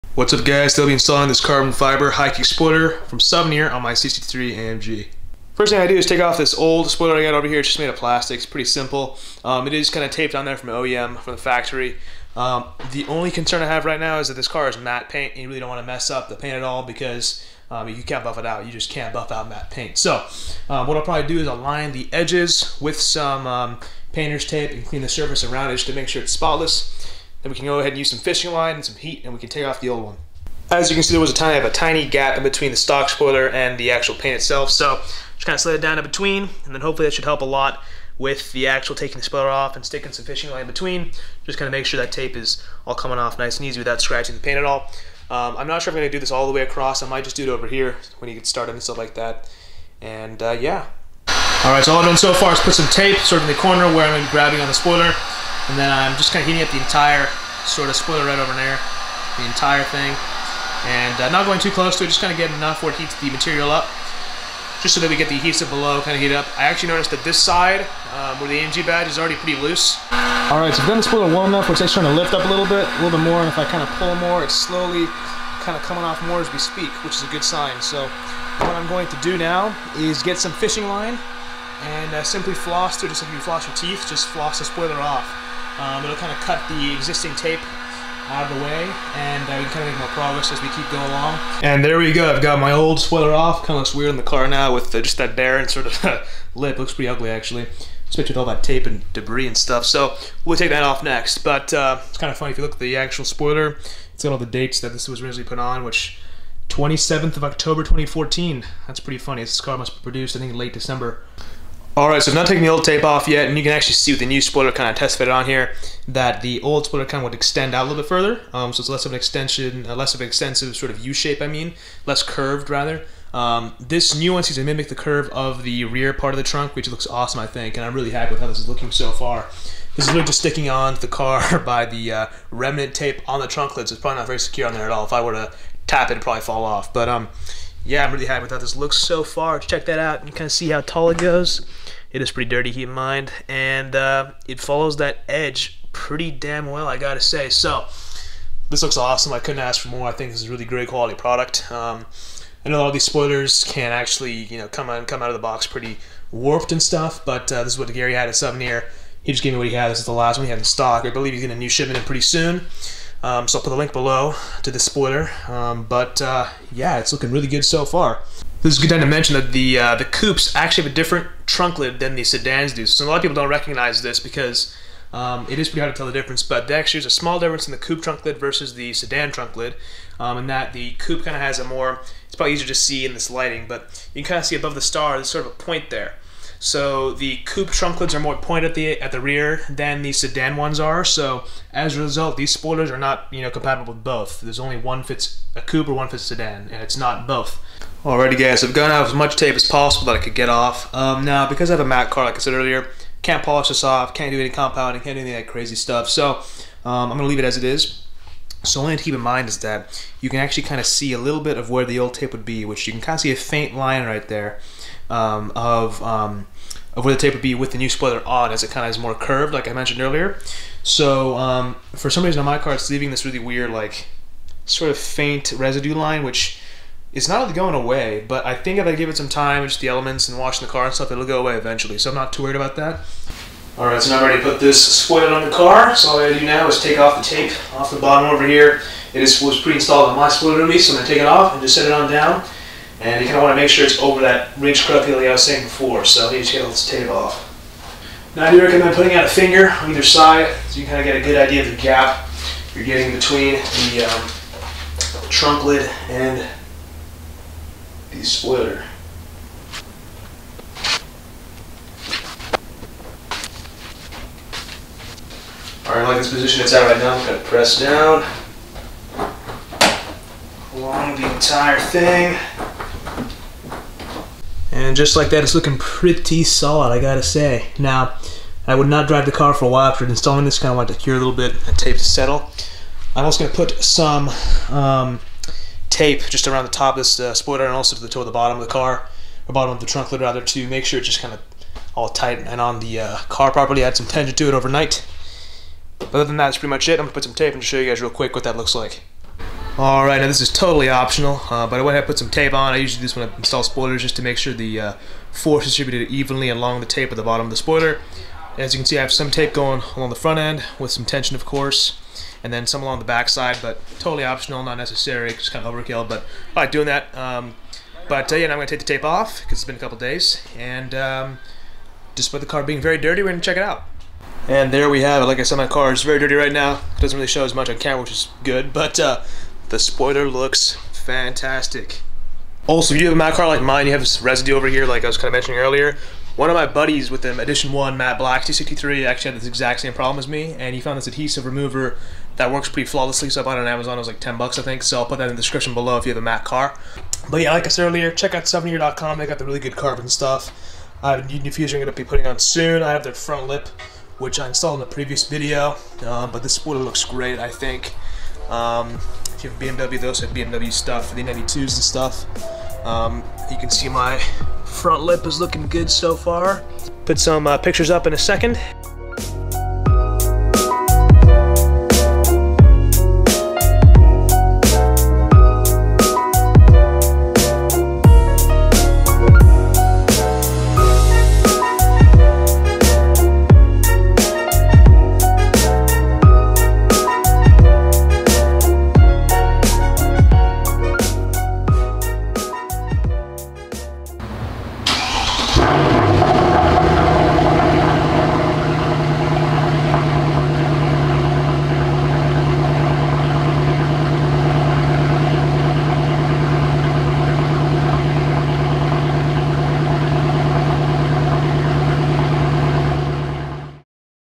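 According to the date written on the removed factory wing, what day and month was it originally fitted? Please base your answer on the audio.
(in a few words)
27th of October.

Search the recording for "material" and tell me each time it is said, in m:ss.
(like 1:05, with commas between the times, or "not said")
1:03.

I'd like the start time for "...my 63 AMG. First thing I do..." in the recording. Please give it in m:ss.
0:03.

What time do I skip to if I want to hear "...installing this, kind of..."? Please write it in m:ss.
4:40.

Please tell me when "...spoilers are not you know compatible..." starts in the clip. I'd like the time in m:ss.
3:12.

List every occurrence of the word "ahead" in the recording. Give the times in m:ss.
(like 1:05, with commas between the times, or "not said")
0:27, 5:01.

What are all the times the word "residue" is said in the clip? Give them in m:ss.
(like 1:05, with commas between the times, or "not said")
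3:45, 5:34.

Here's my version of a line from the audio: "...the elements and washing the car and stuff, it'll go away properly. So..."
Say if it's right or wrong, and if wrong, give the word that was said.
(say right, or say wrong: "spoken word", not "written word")
wrong: "eventually", not "properly".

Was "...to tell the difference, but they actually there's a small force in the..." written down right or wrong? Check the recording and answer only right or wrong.
wrong.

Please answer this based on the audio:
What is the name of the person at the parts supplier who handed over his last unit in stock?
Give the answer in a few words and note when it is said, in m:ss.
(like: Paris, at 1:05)
Gary, at 2:37.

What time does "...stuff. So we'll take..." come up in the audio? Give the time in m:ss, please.
1:39.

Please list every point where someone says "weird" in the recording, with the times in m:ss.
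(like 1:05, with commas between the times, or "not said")
1:33, 3:43.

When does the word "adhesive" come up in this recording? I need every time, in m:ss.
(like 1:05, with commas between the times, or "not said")
1:05, 5:41.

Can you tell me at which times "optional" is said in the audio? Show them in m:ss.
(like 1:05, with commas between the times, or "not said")
5:00, 5:14.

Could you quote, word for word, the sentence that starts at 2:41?
I believe he's getting a new shipment in pretty soon.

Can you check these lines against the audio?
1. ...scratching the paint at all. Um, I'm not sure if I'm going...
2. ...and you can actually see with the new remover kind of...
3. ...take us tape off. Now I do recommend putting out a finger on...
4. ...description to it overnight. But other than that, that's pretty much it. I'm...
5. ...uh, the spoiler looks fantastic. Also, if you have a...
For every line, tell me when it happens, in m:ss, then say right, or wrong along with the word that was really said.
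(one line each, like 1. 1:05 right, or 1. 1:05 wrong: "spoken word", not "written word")
1. 0:44 right
2. 1:53 wrong: "spoiler", not "remover"
3. 4:06 right
4. 4:54 wrong: "tension", not "description"
5. 5:28 right.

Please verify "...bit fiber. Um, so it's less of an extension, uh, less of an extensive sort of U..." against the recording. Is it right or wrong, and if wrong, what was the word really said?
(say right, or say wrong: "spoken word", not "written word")
wrong: "further", not "fiber".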